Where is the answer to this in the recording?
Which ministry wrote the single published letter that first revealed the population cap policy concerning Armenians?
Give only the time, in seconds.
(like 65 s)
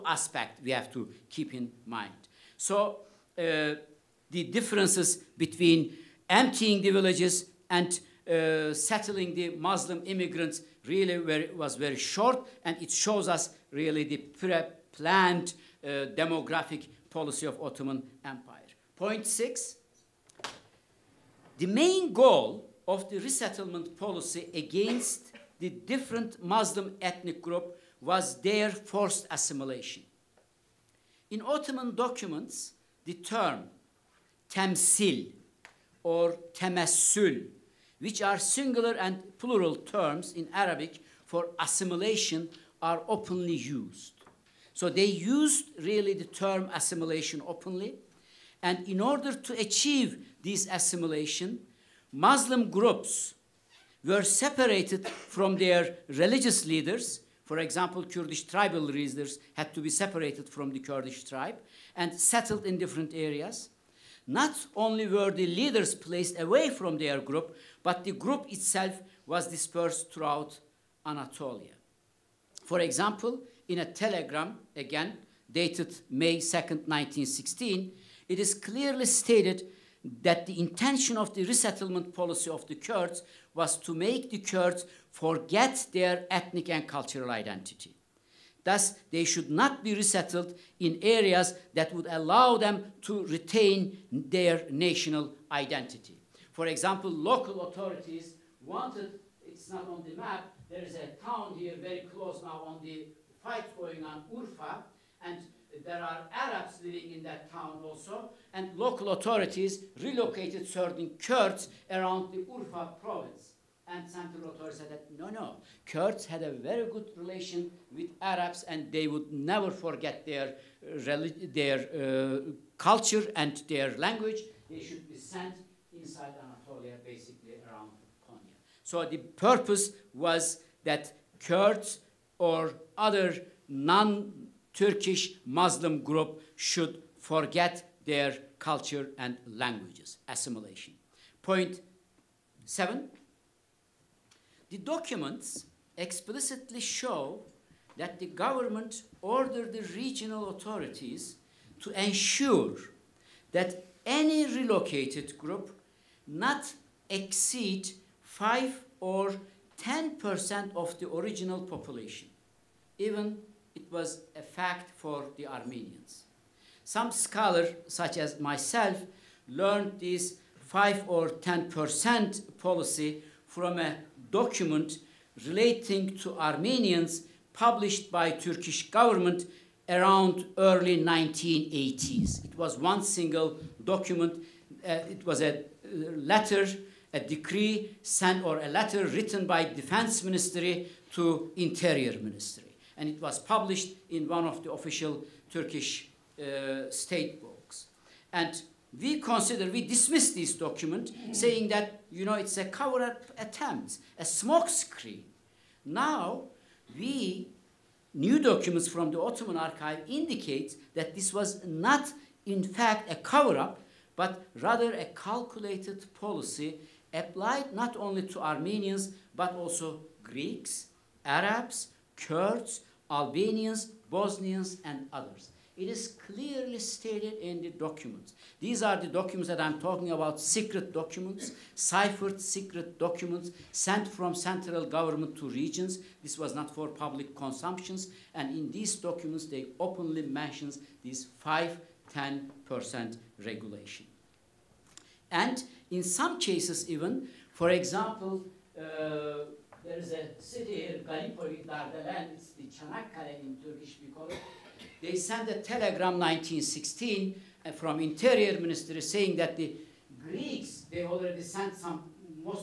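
189 s.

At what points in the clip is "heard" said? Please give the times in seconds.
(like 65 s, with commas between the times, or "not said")
not said.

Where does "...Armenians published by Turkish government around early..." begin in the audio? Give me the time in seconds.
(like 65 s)
176 s.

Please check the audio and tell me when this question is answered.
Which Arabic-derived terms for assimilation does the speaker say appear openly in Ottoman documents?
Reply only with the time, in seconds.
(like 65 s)
34 s.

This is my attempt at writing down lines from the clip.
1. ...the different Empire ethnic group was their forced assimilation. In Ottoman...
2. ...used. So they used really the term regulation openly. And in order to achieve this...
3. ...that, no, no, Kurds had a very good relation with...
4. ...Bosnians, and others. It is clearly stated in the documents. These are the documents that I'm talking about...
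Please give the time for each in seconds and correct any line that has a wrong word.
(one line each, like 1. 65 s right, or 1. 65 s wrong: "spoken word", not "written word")
1. 25 s wrong: "Muslim", not "Empire"
2. 43 s wrong: "assimilation", not "regulation"
3. 114 s right
4. 224 s right.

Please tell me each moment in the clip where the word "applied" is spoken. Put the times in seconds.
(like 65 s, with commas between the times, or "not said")
217 s.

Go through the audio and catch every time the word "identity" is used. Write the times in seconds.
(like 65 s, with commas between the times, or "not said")
87 s, 95 s.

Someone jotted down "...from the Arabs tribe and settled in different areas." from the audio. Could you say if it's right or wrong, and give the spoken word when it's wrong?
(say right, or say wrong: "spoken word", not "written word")
wrong: "Kurdish", not "Arabs".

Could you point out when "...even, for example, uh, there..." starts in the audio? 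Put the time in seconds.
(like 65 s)
246 s.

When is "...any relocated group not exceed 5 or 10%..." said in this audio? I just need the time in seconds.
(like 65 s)
154 s.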